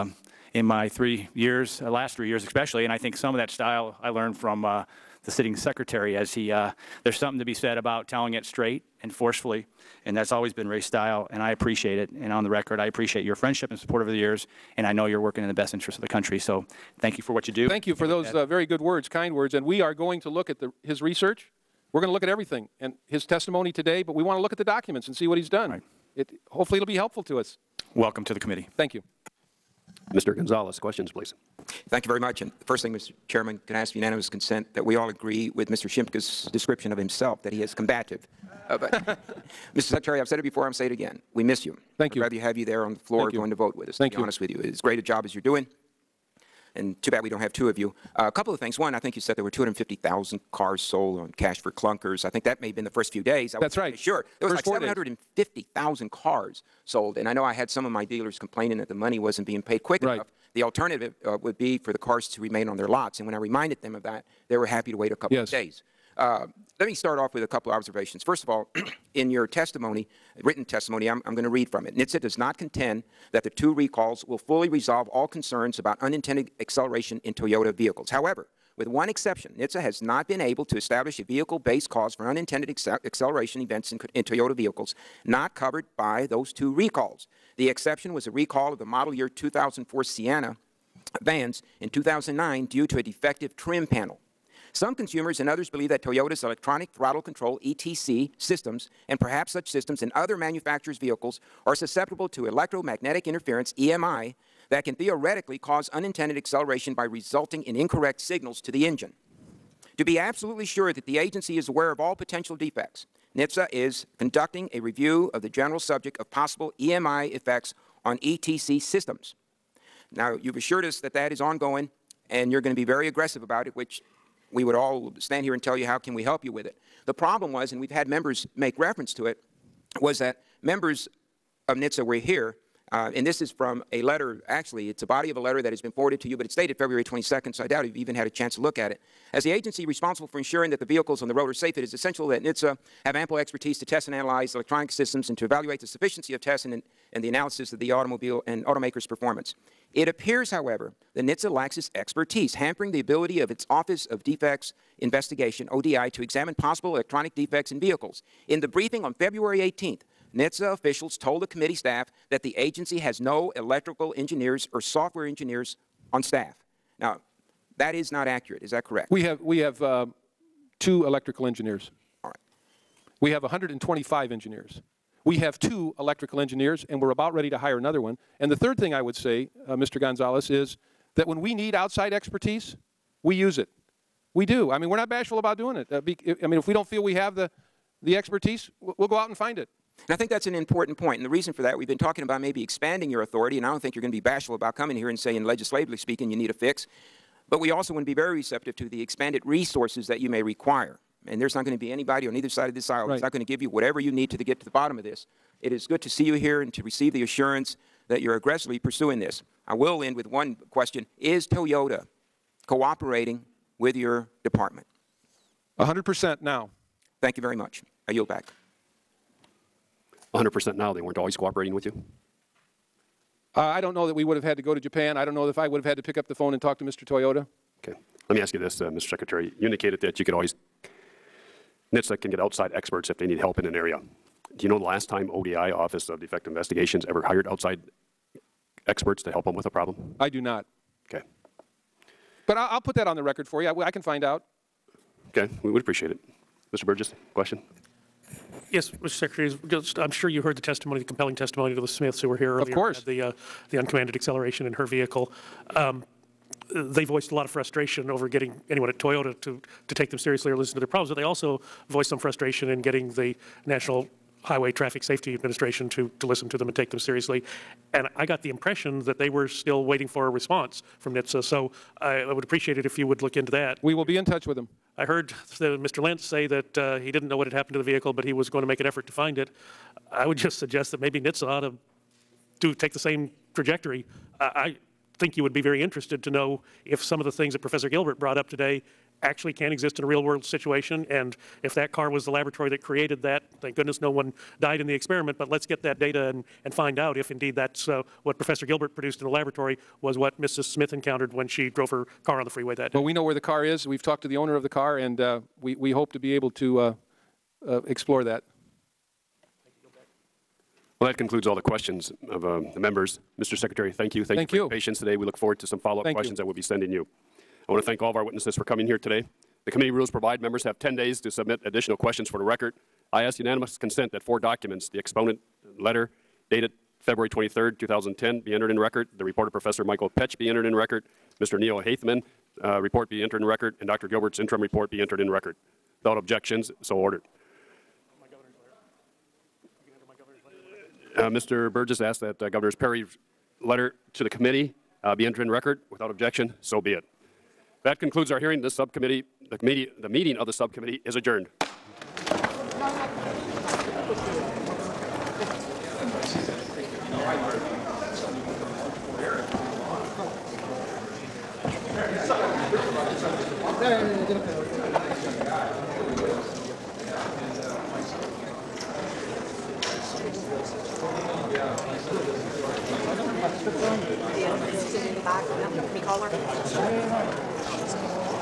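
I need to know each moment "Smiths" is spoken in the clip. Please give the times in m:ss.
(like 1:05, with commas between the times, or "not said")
4:11, 5:00.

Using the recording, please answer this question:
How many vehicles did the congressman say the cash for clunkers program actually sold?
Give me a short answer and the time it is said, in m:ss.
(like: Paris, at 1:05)
750,000, at 0:54.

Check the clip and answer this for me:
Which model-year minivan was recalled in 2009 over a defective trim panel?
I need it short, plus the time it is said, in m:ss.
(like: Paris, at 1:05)
2004 Sienna, at 1:29.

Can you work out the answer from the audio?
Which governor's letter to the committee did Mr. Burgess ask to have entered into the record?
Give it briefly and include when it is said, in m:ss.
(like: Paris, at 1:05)
Governor Perry, at 5:42.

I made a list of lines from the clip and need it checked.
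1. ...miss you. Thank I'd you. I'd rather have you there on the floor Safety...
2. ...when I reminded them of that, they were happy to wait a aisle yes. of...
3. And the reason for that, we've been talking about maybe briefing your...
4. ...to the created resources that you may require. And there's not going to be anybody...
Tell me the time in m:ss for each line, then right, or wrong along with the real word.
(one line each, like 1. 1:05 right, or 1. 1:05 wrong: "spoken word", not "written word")
1. 0:41 wrong: "Thank", not "Safety"
2. 1:03 wrong: "couple", not "aisle"
3. 3:11 wrong: "expanding", not "briefing"
4. 3:18 wrong: "expanded", not "created".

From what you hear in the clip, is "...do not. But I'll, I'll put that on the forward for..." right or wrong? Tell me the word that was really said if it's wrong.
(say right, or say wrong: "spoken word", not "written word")
wrong: "record", not "forward".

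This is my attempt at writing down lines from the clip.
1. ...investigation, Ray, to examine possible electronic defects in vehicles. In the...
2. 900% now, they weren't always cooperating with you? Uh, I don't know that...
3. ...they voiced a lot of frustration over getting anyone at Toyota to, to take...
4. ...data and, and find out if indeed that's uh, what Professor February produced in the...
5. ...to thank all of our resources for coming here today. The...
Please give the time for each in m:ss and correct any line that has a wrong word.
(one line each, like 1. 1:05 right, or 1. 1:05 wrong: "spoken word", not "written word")
1. 2:34 wrong: "ODI", not "Ray"
2. 3:40 wrong: "100", not "900"
3. 4:16 right
4. 4:55 wrong: "Gilbert", not "February"
5. 5:17 wrong: "witnesses", not "resources".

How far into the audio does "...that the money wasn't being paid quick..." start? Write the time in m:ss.
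0:58.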